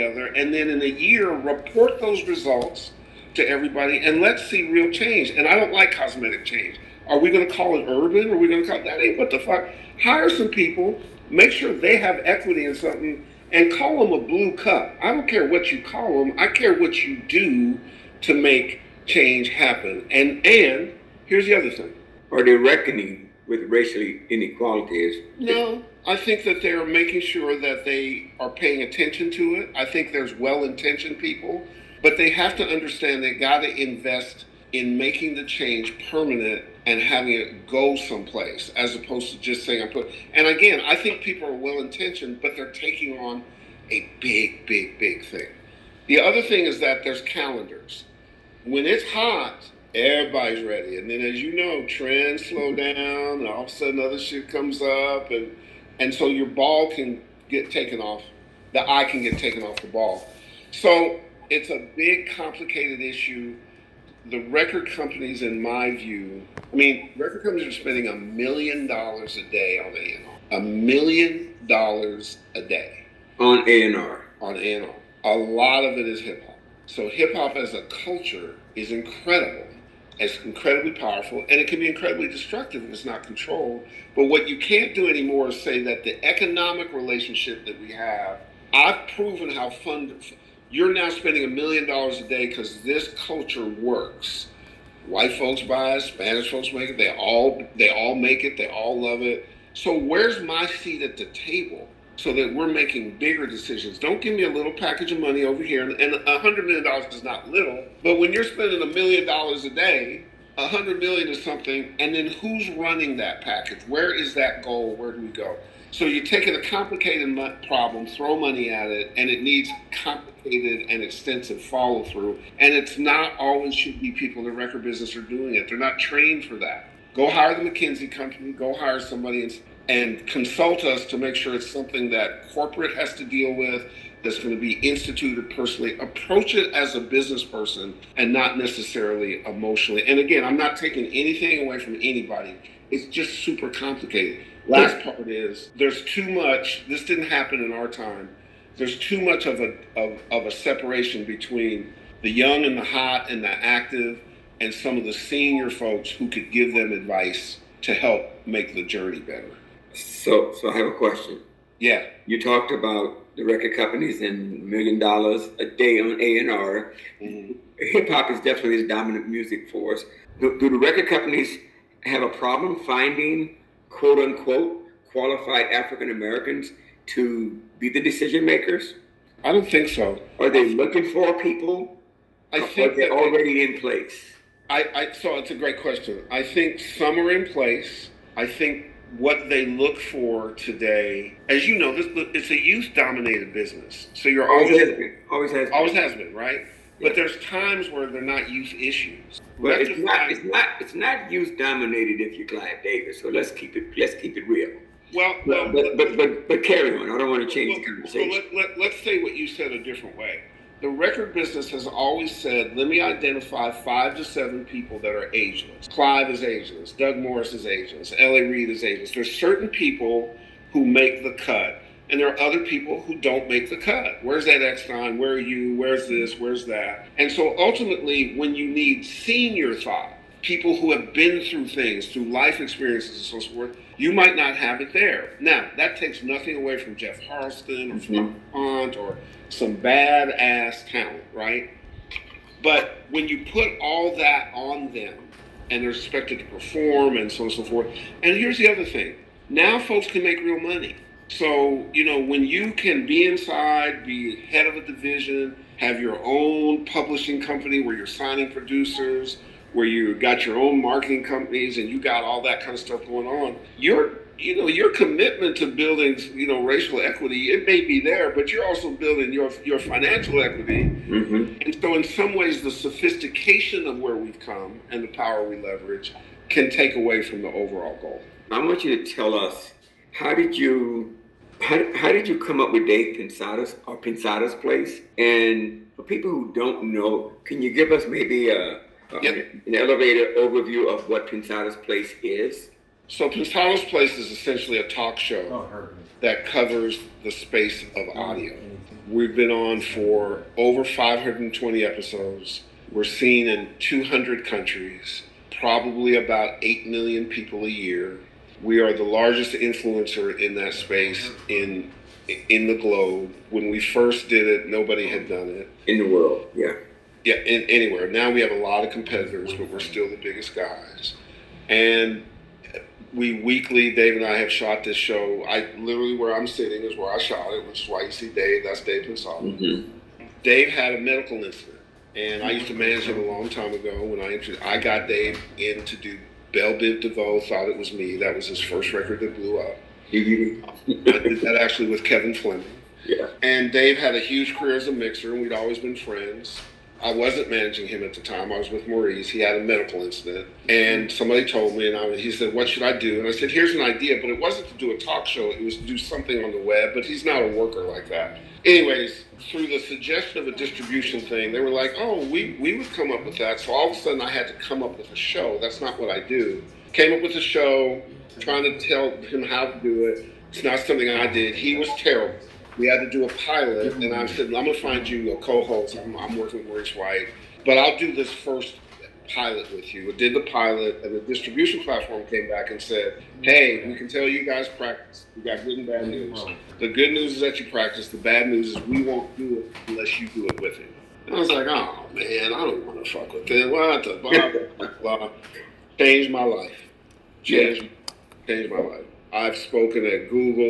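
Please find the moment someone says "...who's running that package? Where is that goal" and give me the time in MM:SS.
01:52.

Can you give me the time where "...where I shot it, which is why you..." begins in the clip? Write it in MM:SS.
05:26.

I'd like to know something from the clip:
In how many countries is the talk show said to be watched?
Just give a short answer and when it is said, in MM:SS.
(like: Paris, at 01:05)
200, at 05:03.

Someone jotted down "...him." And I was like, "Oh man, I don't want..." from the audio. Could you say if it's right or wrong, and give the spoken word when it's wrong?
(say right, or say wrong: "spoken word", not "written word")
right.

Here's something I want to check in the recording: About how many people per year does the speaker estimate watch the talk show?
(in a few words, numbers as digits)
8 million.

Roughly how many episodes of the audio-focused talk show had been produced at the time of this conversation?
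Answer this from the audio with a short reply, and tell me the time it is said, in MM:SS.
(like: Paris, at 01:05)
520, at 05:00.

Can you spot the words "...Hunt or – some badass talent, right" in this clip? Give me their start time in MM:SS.
03:58.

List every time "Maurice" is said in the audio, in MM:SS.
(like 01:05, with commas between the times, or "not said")
05:48, 06:16.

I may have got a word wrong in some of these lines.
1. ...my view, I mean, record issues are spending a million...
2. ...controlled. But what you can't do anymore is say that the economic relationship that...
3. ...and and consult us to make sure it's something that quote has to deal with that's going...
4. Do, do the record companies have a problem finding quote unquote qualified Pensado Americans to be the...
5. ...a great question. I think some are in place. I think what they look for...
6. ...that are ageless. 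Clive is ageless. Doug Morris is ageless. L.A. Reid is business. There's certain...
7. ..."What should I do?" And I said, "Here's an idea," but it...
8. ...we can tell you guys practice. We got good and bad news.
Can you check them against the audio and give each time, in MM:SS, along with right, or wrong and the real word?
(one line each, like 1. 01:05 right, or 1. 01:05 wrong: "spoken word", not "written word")
1. 01:05 wrong: "companies", not "issues"
2. 01:23 right
3. 02:09 wrong: "corporate", not "quote"
4. 02:50 wrong: "African", not "Pensado"
5. 03:05 right
6. 03:34 wrong: "ageless", not "business"
7. 05:52 right
8. 06:23 right.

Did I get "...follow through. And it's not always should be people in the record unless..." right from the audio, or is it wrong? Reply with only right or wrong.
wrong.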